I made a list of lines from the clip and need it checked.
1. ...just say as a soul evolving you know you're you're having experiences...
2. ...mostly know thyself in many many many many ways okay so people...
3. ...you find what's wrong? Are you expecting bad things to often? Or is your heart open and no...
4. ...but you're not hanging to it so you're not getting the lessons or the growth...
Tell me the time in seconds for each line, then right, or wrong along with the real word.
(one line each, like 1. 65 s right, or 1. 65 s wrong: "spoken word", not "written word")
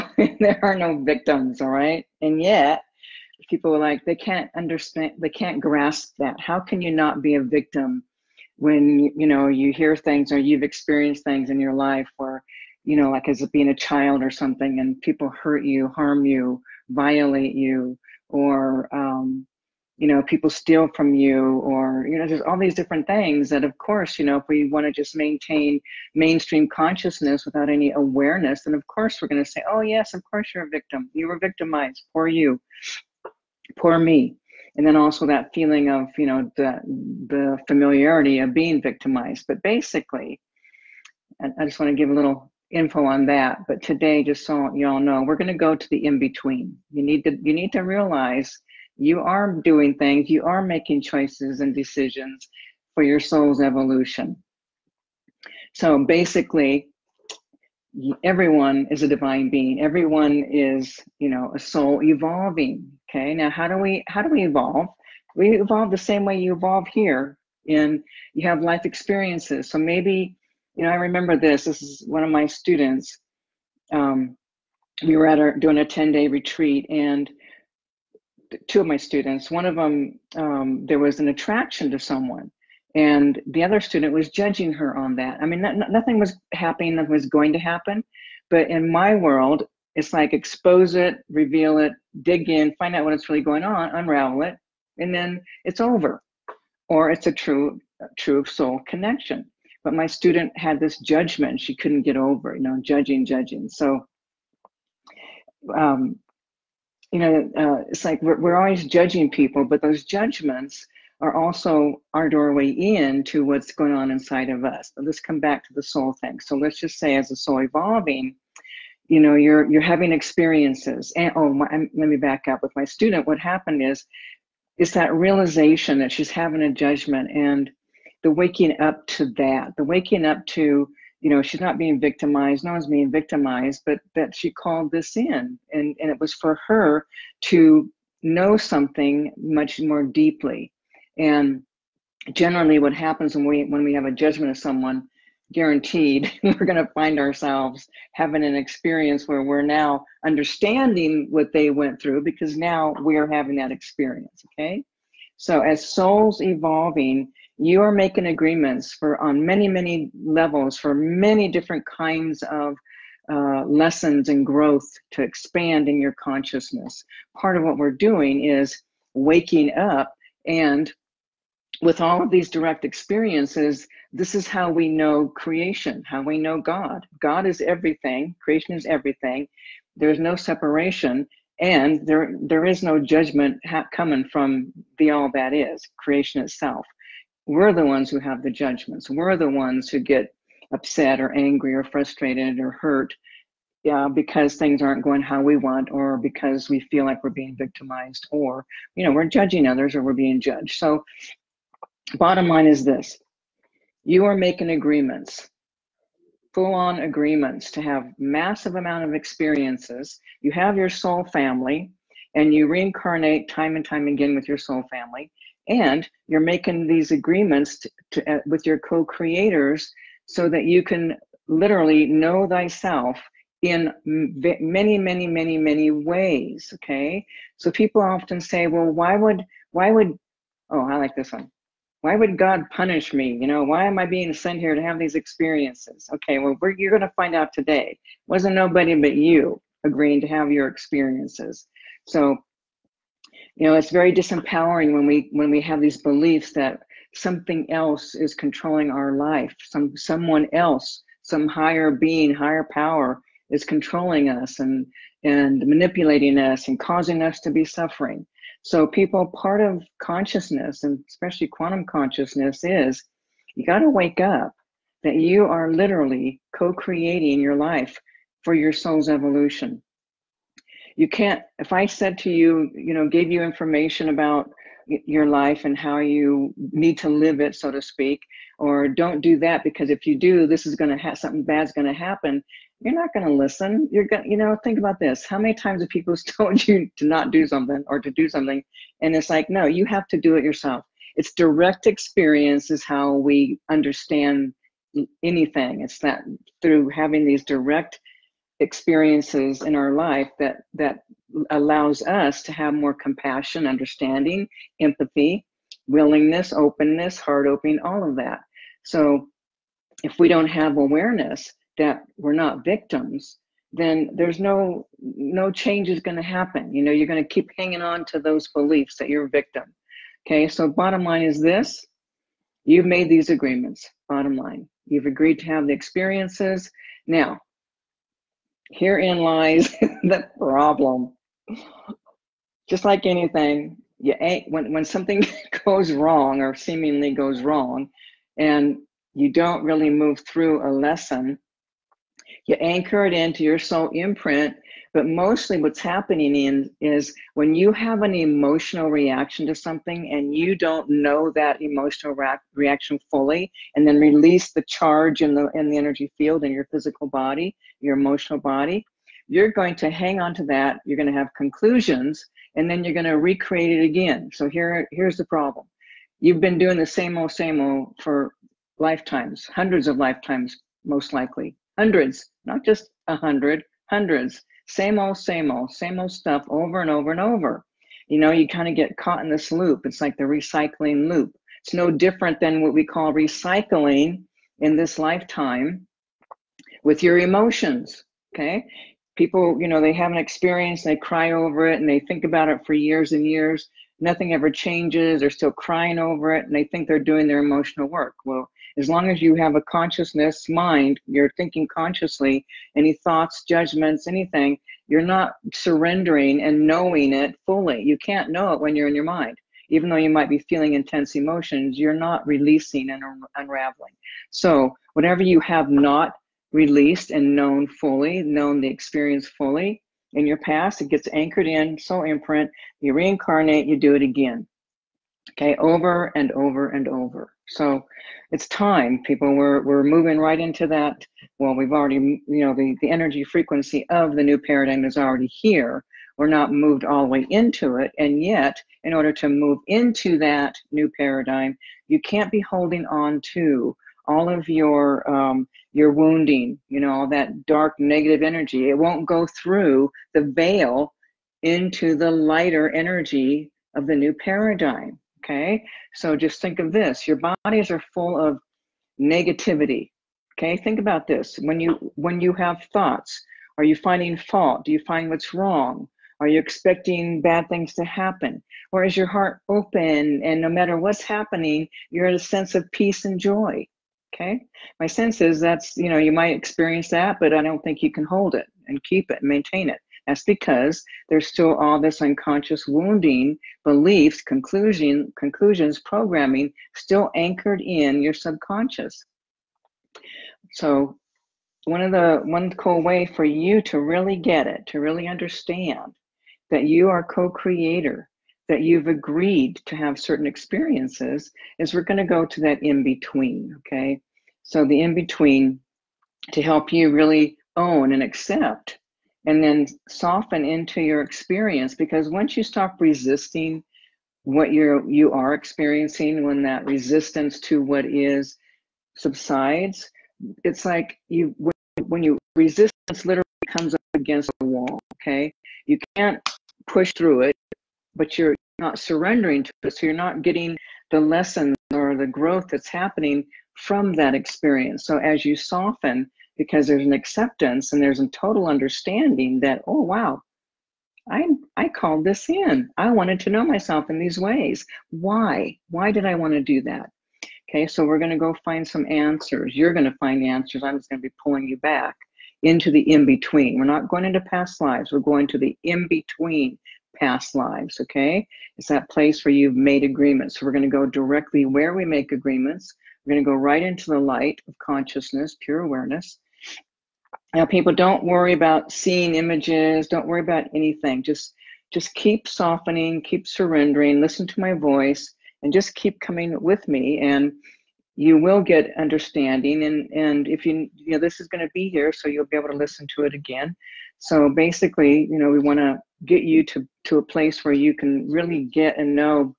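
1. 116 s right
2. 221 s wrong: "literally", not "mostly"
3. 464 s wrong: "happen", not "often"
4. 527 s wrong: "surrendering", not "hanging".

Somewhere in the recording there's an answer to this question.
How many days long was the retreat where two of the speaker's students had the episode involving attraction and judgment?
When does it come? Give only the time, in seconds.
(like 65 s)
75 s.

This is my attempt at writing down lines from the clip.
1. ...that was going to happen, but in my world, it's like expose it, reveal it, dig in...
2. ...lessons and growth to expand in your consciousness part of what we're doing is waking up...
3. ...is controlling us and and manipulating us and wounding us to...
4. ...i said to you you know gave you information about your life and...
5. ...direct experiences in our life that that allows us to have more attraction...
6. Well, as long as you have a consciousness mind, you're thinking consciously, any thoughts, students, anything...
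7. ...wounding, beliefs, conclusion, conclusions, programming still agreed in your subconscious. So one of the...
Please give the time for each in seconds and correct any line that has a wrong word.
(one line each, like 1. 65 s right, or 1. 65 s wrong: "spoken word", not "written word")
1. 86 s right
2. 163 s right
3. 253 s wrong: "causing", not "wounding"
4. 271 s right
5. 297 s wrong: "compassion", not "attraction"
6. 398 s wrong: "judgments", not "students"
7. 482 s wrong: "anchored", not "agreed".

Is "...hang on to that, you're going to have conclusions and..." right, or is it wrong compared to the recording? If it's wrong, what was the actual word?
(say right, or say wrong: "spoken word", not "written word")
right.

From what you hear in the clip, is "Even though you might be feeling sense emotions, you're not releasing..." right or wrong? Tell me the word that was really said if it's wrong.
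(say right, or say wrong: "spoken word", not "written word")
wrong: "intense", not "sense".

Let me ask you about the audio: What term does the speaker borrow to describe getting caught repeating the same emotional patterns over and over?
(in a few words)
Recycling loop.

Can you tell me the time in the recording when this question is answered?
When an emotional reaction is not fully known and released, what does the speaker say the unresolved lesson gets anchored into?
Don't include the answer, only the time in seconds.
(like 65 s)
343 s.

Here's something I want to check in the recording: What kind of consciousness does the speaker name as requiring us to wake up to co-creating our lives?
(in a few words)
Quantum consciousness.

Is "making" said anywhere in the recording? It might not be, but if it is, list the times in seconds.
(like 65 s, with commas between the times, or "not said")
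50 s, 157 s, 204 s, 216 s.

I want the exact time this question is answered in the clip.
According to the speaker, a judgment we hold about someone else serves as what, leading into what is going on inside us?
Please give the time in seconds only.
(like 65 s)
112 s.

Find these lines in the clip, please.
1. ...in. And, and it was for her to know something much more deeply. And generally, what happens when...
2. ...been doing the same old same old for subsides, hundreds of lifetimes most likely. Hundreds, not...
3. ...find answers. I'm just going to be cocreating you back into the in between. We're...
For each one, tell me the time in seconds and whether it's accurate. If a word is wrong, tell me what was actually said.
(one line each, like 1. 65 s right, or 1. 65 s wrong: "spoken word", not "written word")
1. 135 s right
2. 366 s wrong: "lifetimes", not "subsides"
3. 549 s wrong: "pulling", not "cocreating".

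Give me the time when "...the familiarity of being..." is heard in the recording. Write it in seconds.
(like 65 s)
37 s.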